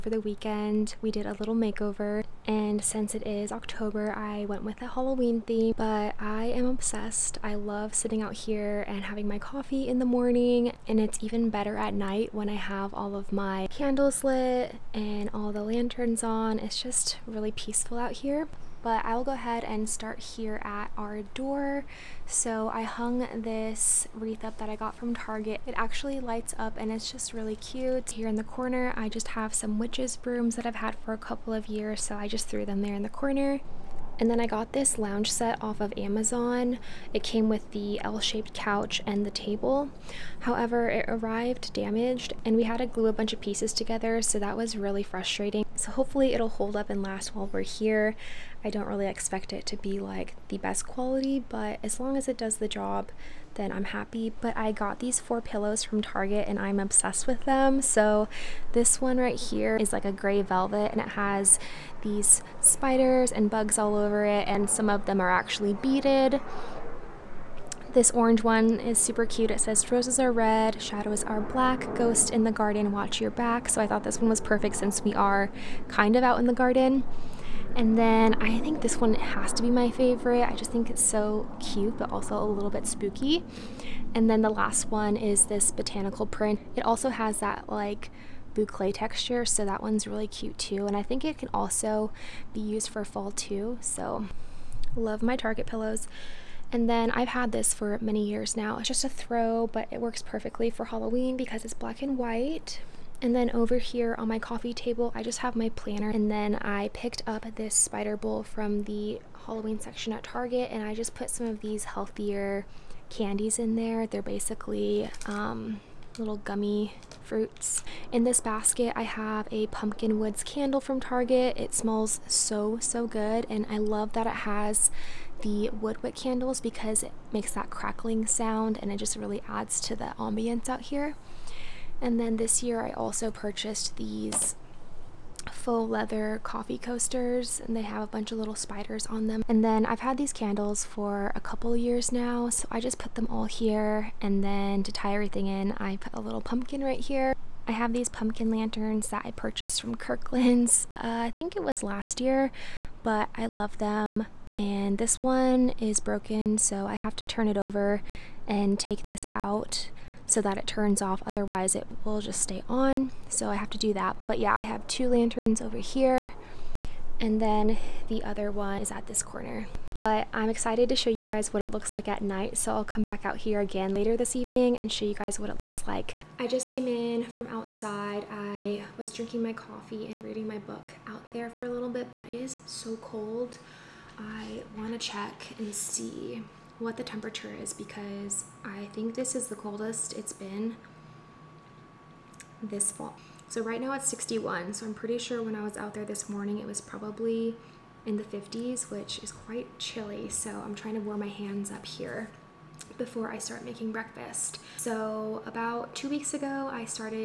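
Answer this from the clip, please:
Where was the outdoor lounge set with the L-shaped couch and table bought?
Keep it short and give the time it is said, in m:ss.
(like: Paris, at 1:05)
Amazon, at 0:35.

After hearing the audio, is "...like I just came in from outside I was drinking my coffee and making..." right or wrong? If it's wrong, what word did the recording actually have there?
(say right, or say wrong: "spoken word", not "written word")
wrong: "reading", not "making".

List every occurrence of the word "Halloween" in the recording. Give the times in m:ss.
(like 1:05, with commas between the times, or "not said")
0:04, 1:40, 1:49.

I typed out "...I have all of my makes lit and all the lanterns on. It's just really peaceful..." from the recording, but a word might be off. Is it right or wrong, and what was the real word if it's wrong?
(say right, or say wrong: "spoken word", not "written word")
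wrong: "candles", not "makes".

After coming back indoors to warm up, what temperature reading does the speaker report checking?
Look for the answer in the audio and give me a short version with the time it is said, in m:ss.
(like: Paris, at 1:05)
61, at 3:14.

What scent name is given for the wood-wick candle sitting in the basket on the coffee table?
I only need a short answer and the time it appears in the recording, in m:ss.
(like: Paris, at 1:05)
pumpkin woods, at 1:59.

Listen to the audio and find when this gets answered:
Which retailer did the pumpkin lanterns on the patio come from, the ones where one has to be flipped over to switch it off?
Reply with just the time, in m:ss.
2:29.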